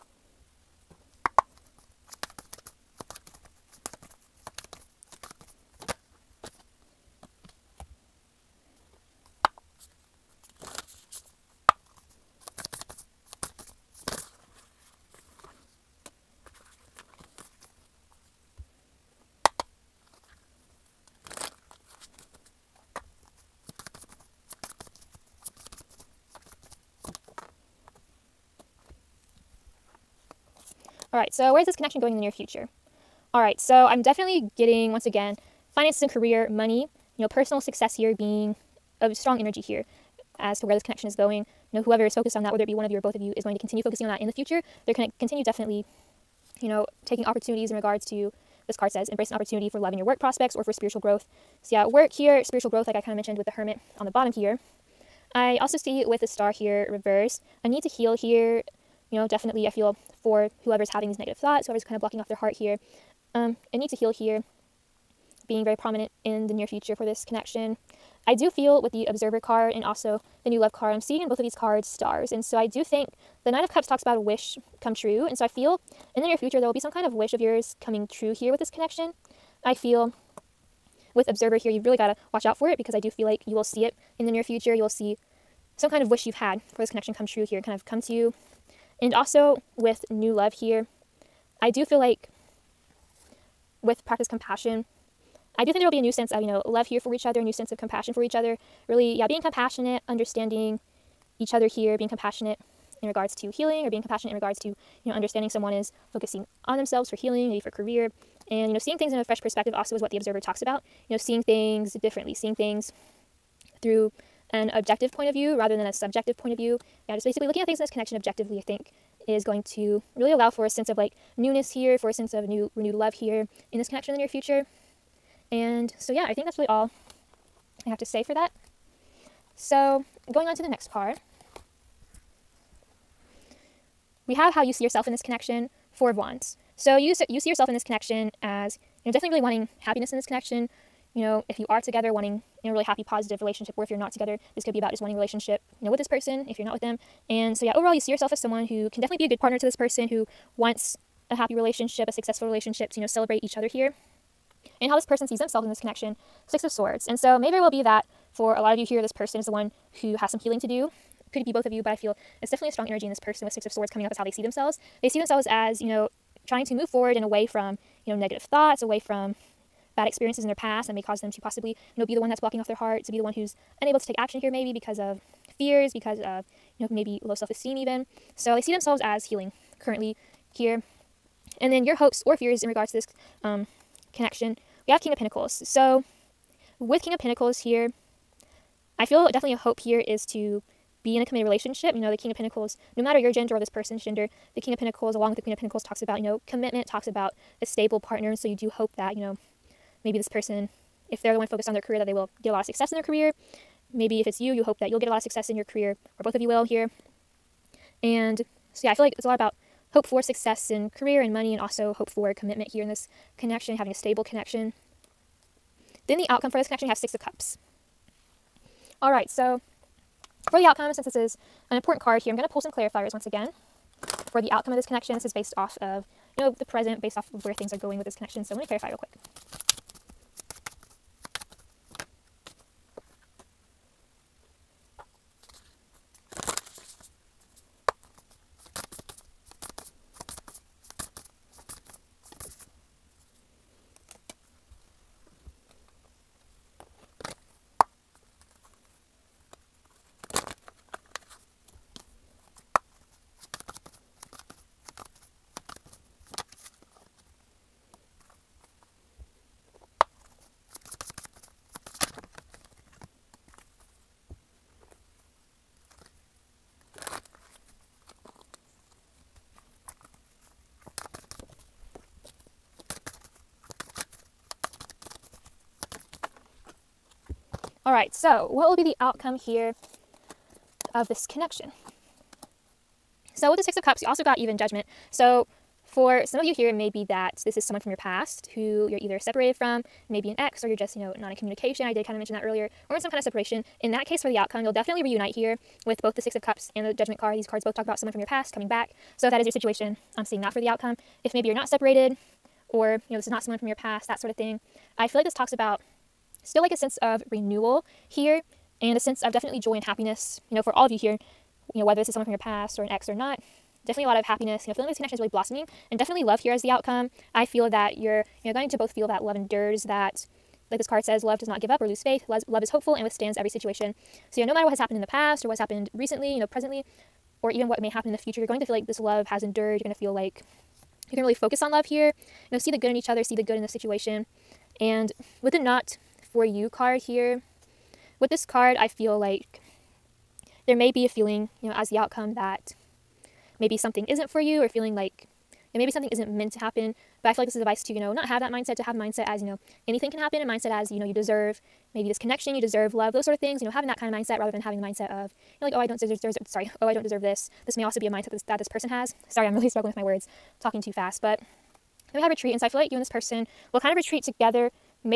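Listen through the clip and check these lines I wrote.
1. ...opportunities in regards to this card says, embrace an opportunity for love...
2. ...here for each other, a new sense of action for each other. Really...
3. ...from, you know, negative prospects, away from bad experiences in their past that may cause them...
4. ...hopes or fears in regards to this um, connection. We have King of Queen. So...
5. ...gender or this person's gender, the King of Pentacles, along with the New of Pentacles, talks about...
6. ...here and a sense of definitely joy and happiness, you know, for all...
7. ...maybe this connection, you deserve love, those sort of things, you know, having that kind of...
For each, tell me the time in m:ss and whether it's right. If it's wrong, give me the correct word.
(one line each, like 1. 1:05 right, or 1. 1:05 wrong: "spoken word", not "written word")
1. 0:47 right
2. 1:36 wrong: "compassion", not "action"
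3. 2:47 wrong: "thoughts", not "prospects"
4. 3:01 wrong: "Pentacles", not "Queen"
5. 3:13 wrong: "Queen", not "New"
6. 5:08 right
7. 5:51 right.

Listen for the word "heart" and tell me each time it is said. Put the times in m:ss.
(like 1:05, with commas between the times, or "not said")
1:02, 2:52.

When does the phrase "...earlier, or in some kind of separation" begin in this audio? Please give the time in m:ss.
4:52.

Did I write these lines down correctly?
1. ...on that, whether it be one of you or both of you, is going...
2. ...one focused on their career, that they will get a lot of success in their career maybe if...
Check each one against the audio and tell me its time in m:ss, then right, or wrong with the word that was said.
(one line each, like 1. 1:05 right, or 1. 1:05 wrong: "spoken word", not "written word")
1. 0:42 right
2. 3:21 right.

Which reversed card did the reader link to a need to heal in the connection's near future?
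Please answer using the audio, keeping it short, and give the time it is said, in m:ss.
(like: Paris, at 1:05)
The Star, at 0:56.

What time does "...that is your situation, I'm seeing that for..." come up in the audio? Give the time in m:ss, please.
4:59.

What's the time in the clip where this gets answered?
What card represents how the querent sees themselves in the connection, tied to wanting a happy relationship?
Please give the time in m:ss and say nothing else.
2:15.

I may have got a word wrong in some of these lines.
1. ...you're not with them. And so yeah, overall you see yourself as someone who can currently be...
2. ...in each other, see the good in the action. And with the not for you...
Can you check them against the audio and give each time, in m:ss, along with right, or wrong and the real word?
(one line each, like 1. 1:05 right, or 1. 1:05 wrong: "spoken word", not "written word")
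1. 2:26 wrong: "definitely", not "currently"
2. 5:32 wrong: "situation", not "action".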